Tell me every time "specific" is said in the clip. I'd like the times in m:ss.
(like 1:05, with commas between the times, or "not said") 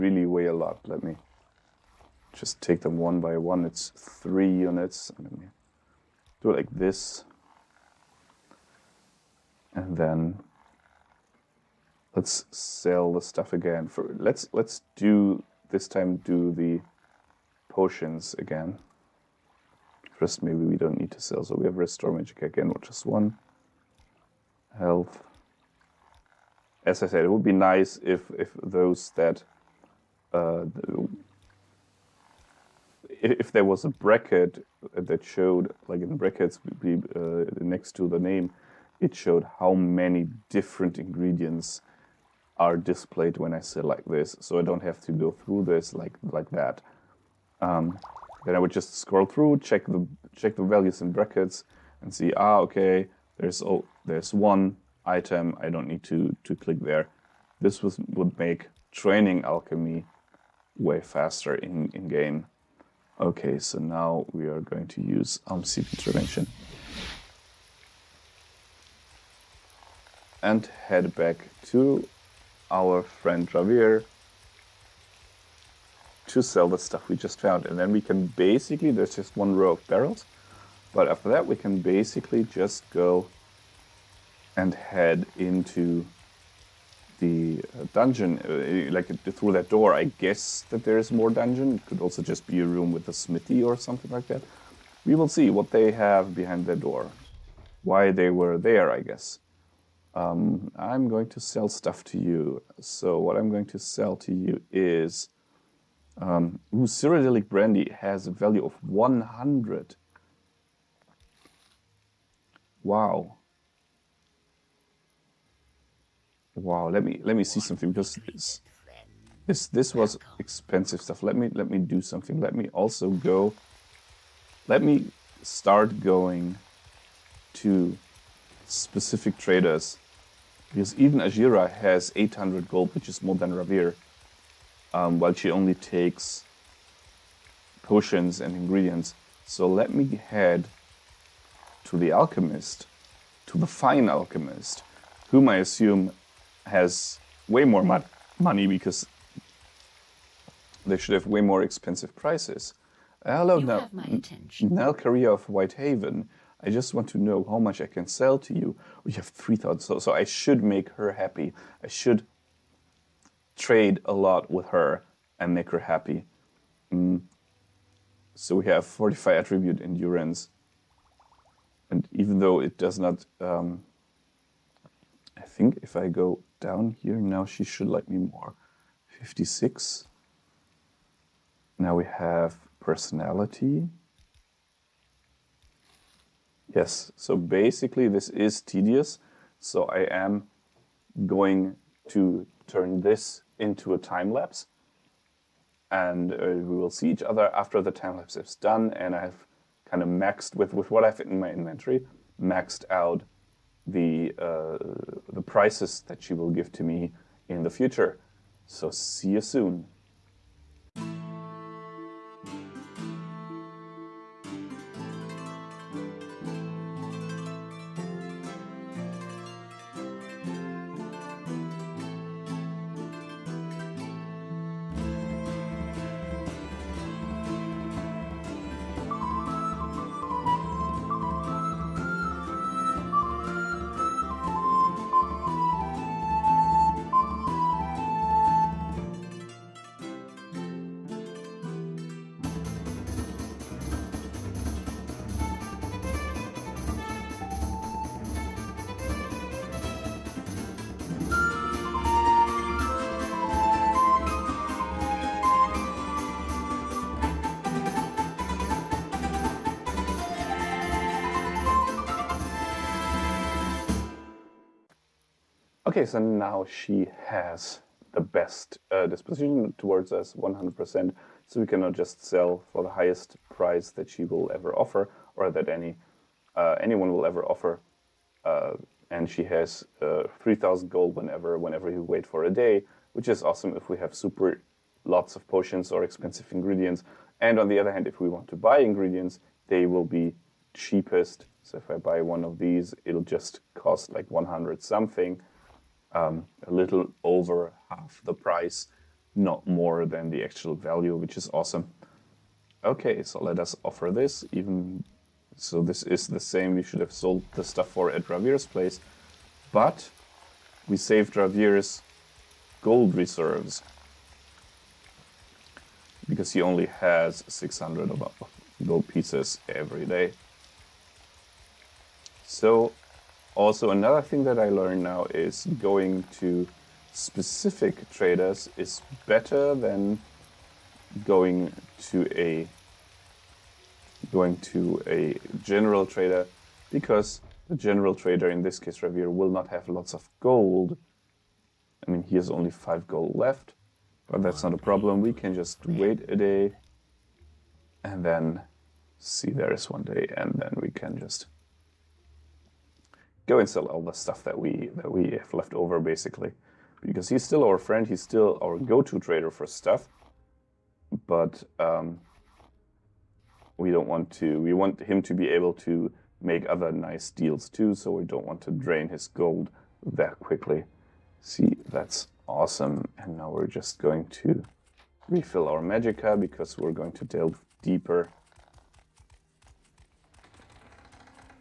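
2:08, 5:27.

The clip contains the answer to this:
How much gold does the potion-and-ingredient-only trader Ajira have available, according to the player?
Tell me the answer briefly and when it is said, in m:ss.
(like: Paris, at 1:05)
800, at 2:12.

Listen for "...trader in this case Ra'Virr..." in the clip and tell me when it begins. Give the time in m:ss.
5:38.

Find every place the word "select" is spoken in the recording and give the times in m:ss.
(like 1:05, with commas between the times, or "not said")
0:43.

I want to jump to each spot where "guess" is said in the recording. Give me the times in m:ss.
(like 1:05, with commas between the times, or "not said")
1:30, 1:39.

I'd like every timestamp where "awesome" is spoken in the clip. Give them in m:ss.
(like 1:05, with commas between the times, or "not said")
4:43, 5:01, 6:12.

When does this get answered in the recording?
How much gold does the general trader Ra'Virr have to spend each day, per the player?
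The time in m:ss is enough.
5:17.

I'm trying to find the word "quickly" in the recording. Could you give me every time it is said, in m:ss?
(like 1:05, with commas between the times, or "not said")
6:10.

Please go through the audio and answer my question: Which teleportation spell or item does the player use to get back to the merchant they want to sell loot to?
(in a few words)
Almsivi Intervention.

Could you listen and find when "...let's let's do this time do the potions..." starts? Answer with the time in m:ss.
0:14.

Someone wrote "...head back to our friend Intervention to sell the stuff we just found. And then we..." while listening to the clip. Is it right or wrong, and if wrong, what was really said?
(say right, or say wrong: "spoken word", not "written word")
wrong: "Javier", not "Intervention".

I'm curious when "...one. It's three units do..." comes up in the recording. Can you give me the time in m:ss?
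0:03.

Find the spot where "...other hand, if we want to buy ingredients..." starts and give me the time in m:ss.
4:47.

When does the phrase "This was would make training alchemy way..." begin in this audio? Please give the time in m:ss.
0:57.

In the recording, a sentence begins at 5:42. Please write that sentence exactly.
I mean he has only five gold left, but that's not a problem.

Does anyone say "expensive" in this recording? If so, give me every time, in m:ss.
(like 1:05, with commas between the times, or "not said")
2:00, 2:31, 4:46.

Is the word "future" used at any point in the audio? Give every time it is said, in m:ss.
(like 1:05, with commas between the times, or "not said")
3:27.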